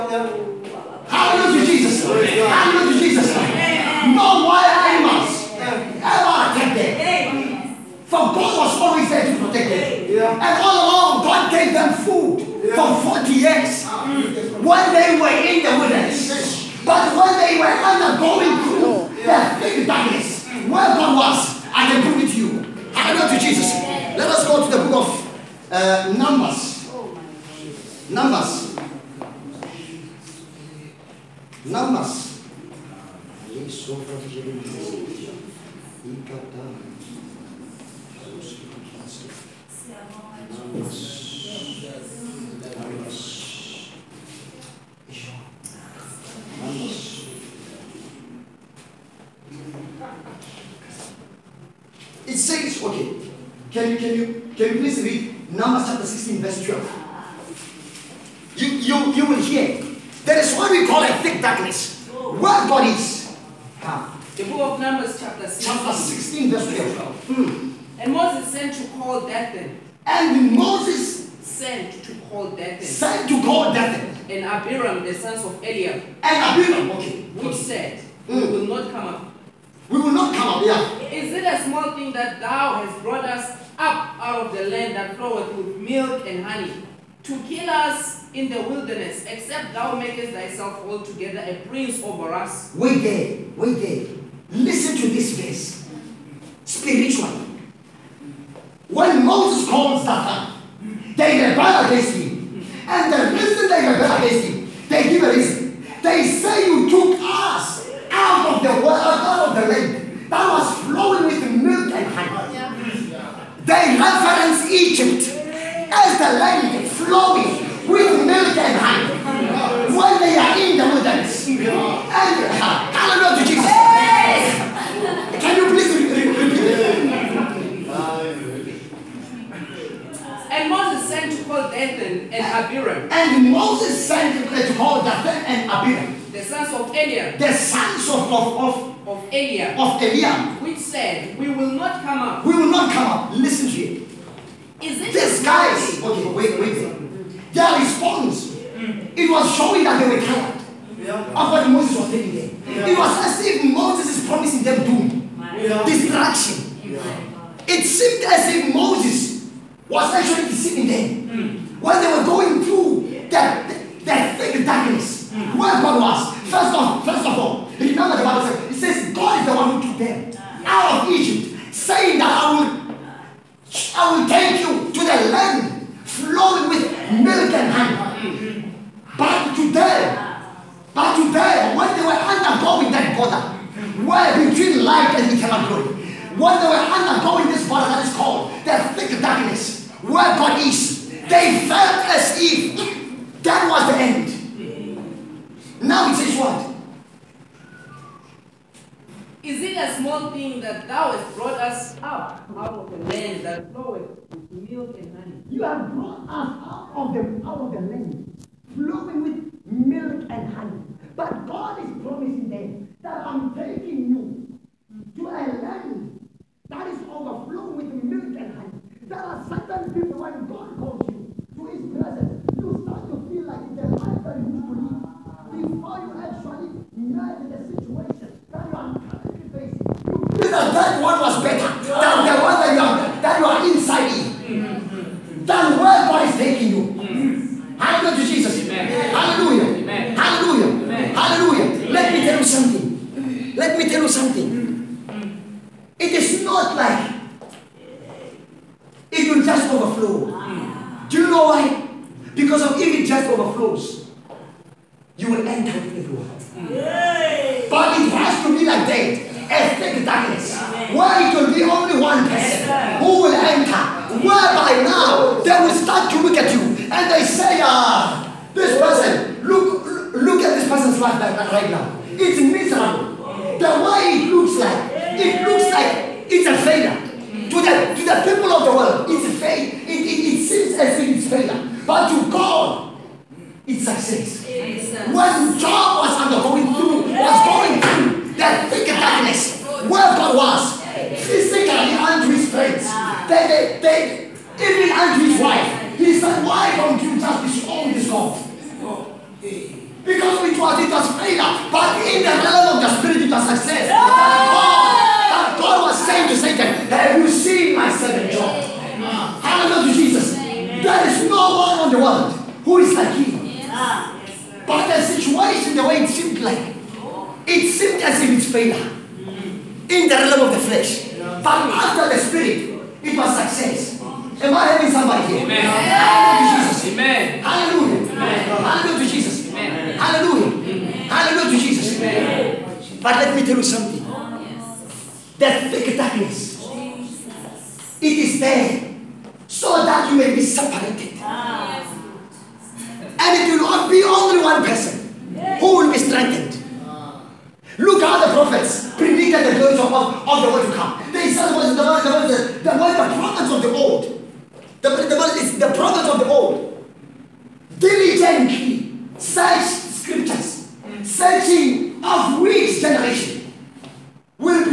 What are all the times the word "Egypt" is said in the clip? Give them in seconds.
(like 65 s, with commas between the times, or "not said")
114 s, 171 s.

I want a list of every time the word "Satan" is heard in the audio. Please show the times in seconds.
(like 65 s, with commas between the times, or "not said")
100 s, 306 s.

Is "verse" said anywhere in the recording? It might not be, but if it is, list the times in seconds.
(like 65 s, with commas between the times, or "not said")
56 s, 66 s, 95 s.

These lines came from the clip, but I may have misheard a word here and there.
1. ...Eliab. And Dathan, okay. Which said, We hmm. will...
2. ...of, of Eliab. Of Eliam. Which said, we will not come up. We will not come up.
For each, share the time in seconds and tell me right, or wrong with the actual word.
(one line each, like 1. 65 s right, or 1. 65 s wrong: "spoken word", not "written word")
1. 75 s wrong: "Abiram", not "Dathan"
2. 138 s right.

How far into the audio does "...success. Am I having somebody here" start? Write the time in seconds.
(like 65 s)
323 s.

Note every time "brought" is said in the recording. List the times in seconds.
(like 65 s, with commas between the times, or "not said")
83 s, 201 s, 205 s.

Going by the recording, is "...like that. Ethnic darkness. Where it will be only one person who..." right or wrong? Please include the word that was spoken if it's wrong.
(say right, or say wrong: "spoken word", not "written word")
right.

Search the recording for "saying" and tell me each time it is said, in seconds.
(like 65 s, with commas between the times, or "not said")
171 s, 306 s.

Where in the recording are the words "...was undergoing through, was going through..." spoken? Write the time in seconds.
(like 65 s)
286 s.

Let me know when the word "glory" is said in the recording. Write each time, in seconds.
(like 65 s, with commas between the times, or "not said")
185 s, 349 s.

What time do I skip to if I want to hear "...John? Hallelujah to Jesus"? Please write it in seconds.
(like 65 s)
308 s.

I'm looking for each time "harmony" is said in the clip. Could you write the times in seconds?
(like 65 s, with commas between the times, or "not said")
not said.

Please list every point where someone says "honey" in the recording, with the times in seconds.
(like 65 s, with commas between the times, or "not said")
86 s, 112 s, 118 s, 177 s, 210 s, 218 s.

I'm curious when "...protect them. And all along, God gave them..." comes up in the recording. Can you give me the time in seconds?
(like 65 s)
9 s.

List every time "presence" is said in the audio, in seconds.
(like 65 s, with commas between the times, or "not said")
221 s.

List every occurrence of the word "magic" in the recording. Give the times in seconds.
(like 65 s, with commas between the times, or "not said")
not said.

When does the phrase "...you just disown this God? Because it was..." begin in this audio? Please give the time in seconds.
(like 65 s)
297 s.